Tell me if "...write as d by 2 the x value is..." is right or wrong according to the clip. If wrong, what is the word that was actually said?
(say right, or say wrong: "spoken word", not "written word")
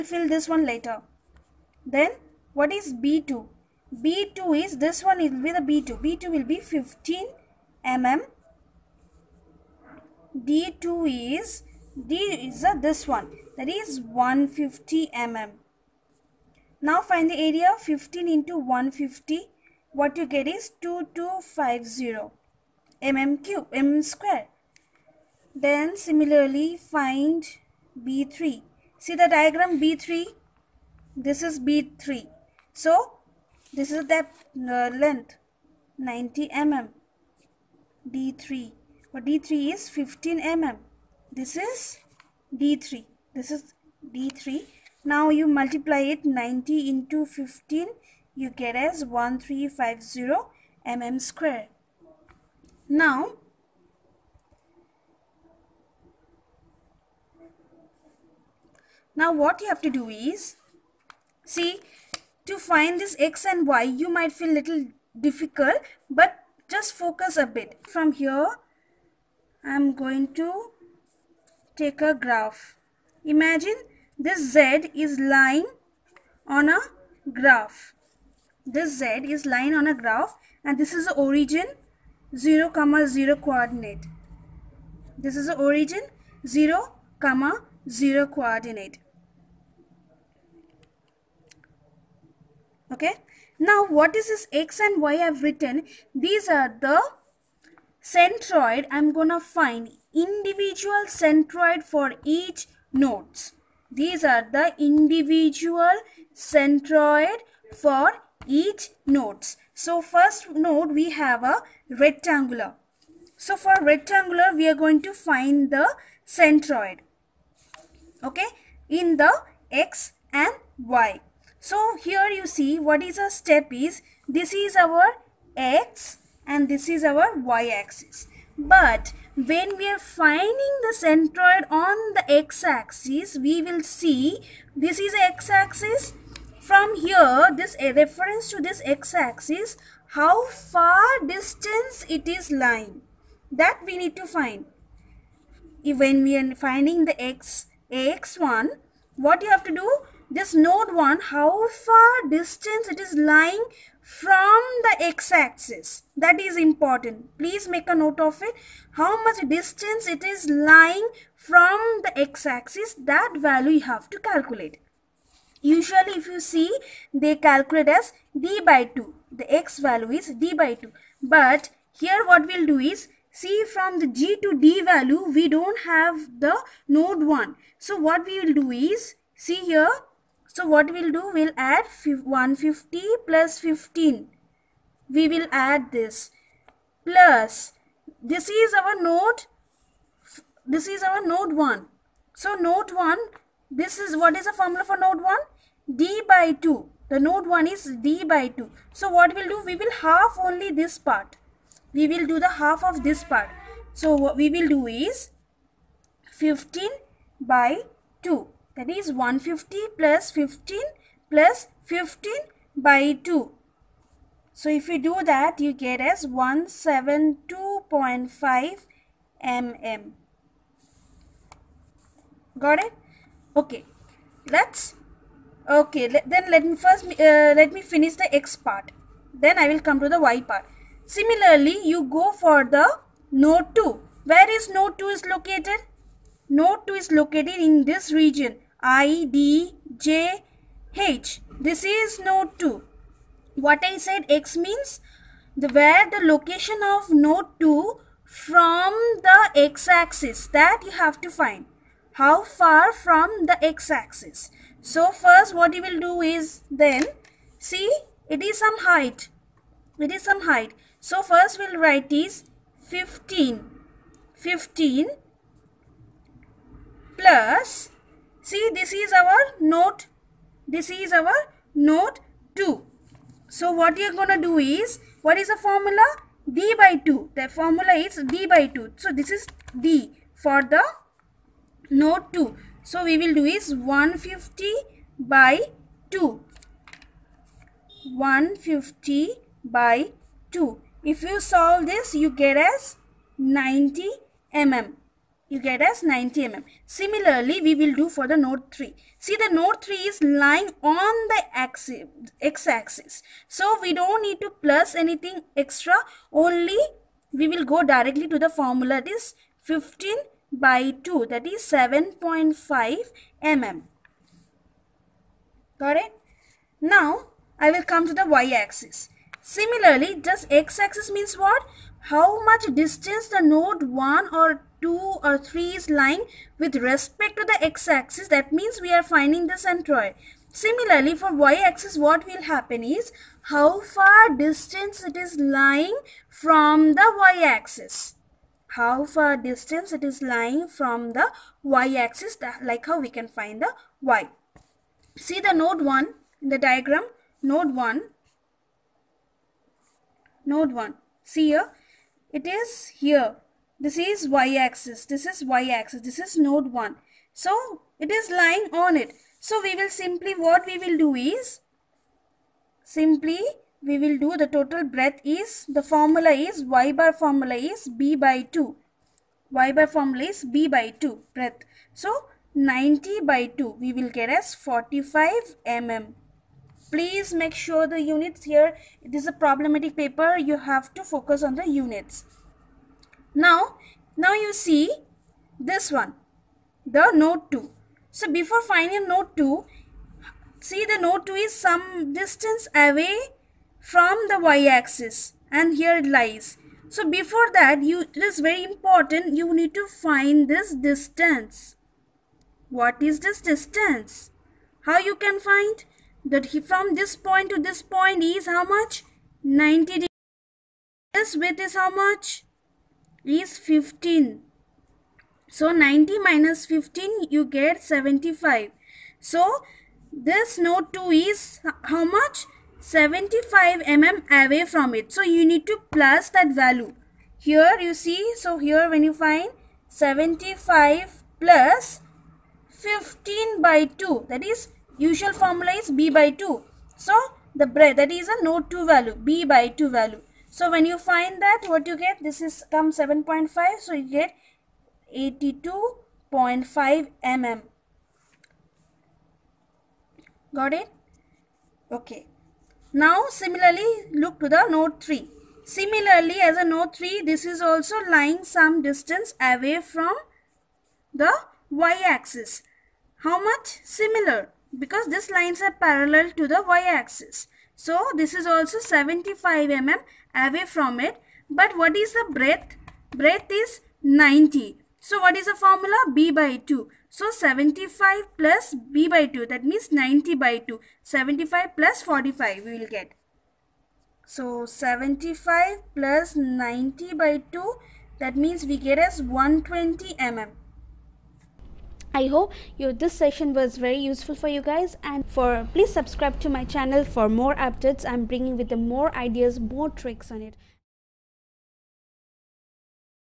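wrong: "calculate", not "write".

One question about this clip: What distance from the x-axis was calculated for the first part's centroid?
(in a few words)
172.5 mm.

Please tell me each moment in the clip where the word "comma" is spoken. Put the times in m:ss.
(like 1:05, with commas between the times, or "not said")
1:22, 1:27.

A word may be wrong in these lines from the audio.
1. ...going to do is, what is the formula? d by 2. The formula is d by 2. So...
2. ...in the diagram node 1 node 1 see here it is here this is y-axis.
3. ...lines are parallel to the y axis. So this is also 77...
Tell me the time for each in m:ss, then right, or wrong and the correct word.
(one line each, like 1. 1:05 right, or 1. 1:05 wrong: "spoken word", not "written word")
1. 4:34 right
2. 5:46 right
3. 7:45 wrong: "75", not "77".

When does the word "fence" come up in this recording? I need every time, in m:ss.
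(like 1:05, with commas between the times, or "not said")
not said.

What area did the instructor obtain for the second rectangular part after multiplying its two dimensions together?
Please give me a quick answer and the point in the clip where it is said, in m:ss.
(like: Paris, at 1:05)
2250 mm², at 0:20.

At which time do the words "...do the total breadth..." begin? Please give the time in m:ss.
6:04.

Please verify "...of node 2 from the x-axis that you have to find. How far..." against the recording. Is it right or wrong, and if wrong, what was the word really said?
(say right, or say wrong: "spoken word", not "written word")
right.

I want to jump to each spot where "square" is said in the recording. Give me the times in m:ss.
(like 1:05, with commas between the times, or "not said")
0:24, 0:51.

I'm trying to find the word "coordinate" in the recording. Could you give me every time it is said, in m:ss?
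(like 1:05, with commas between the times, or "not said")
1:23, 1:28.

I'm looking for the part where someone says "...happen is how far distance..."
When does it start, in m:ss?
5:32.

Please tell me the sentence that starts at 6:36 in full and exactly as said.
So before that, you it is very important, you need to find this distance.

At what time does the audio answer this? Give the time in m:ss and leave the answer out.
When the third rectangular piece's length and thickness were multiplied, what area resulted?
0:49.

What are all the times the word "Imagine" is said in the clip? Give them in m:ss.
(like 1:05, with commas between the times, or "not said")
1:13.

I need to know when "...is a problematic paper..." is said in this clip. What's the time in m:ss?
6:19.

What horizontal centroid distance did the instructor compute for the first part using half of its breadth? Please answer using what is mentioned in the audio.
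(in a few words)
45 mm.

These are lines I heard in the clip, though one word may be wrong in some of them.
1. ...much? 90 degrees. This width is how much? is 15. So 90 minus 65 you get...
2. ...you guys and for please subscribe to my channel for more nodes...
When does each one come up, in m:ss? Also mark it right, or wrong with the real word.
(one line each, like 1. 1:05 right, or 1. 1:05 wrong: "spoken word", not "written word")
1. 6:48 wrong: "15", not "65"
2. 8:14 wrong: "updates", not "nodes".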